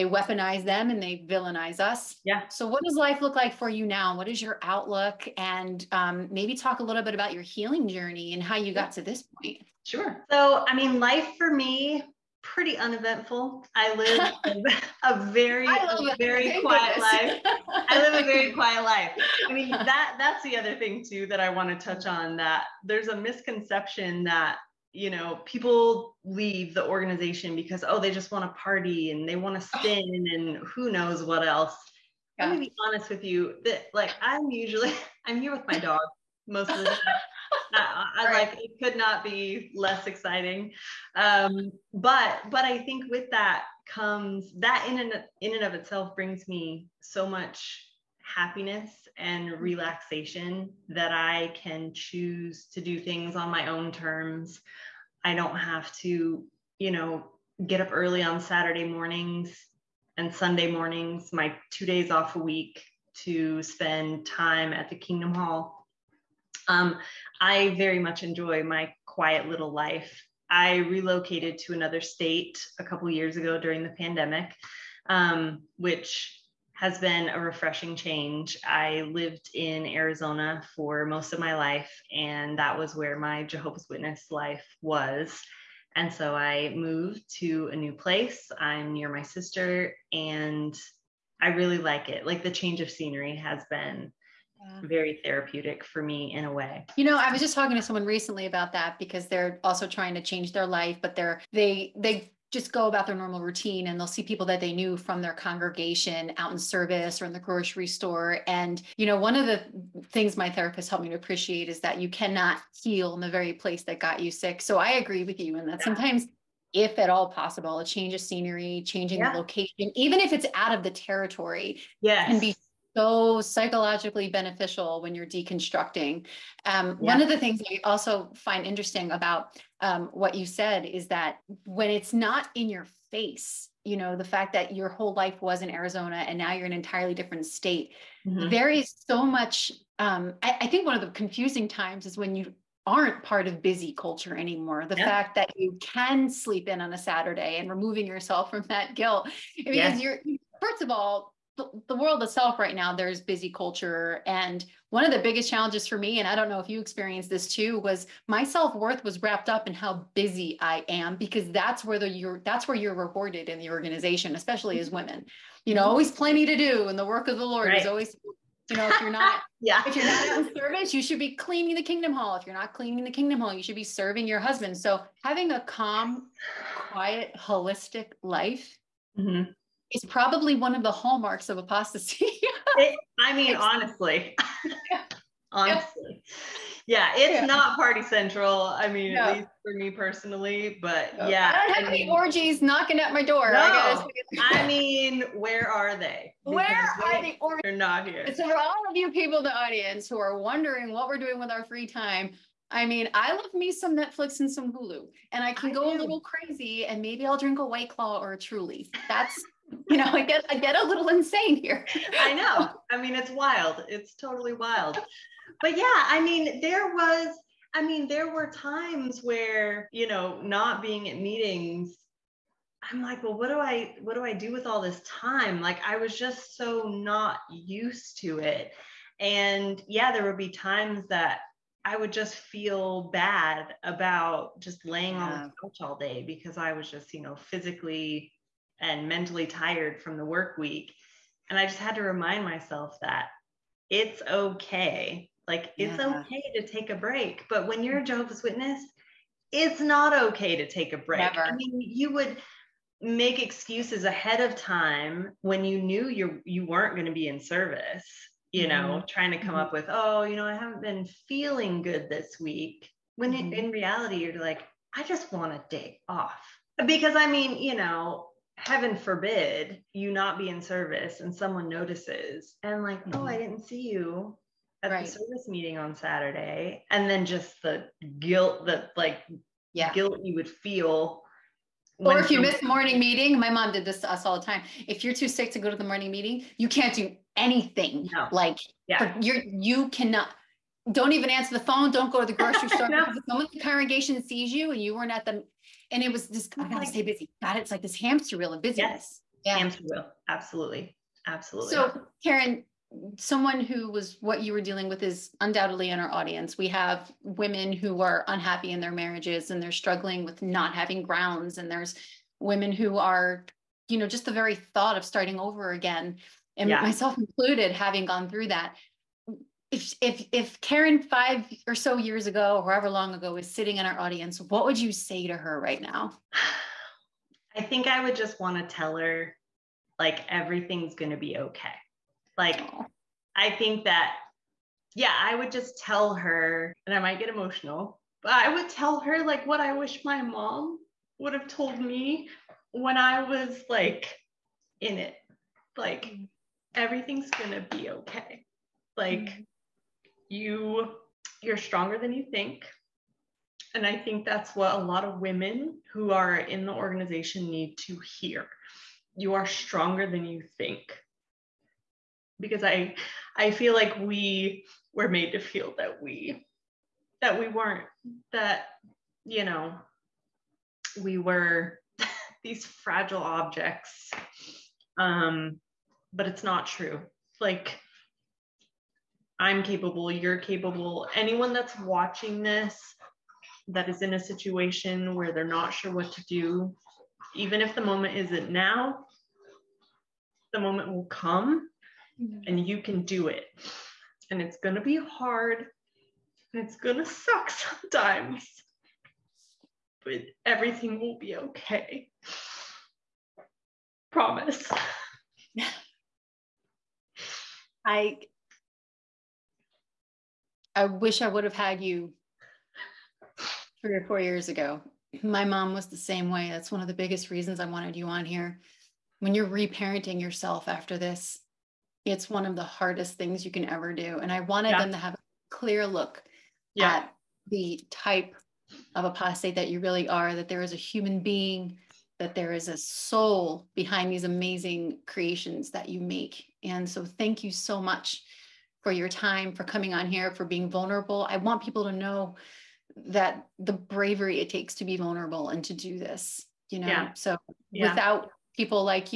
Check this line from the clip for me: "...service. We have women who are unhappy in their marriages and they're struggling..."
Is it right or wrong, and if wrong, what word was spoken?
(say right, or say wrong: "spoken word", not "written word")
wrong: "audience", not "service".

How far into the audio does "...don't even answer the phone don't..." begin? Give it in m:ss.
4:50.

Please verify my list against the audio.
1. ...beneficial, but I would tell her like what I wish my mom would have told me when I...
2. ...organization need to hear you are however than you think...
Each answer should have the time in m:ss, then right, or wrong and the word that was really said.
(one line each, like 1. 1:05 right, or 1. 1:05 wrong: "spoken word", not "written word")
1. 5:37 wrong: "emotional", not "beneficial"
2. 5:56 wrong: "stronger", not "however".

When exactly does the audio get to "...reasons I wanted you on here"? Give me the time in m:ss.
6:57.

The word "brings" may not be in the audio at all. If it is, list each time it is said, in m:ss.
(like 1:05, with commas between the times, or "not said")
0:46.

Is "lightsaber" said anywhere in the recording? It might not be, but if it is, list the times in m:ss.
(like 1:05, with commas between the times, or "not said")
not said.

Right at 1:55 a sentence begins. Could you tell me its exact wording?
sometimes if at all possible a change of scenery changing yeah.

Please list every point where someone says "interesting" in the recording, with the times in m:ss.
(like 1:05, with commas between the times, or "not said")
2:08.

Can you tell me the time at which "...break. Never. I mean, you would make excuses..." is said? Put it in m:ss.
4:10.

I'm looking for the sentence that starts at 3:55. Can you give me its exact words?
on the couch all day because I was just, you know, physically and mentally tired from the work week.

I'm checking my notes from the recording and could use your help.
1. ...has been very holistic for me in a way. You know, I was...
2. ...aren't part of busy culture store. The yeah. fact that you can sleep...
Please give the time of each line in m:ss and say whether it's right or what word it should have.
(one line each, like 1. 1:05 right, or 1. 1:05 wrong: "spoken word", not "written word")
1. 1:33 wrong: "therapeutic", not "holistic"
2. 2:22 wrong: "anymore", not "store".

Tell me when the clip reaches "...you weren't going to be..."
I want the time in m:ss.
4:16.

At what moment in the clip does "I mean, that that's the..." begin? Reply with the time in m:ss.
0:19.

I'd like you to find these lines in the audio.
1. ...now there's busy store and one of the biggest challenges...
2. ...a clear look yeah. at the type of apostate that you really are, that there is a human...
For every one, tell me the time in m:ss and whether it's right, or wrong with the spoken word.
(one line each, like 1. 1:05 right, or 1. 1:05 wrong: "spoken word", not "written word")
1. 2:32 wrong: "culture", not "store"
2. 7:05 right.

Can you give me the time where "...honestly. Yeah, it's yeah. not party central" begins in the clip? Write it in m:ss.
3:05.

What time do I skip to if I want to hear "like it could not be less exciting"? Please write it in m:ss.
0:38.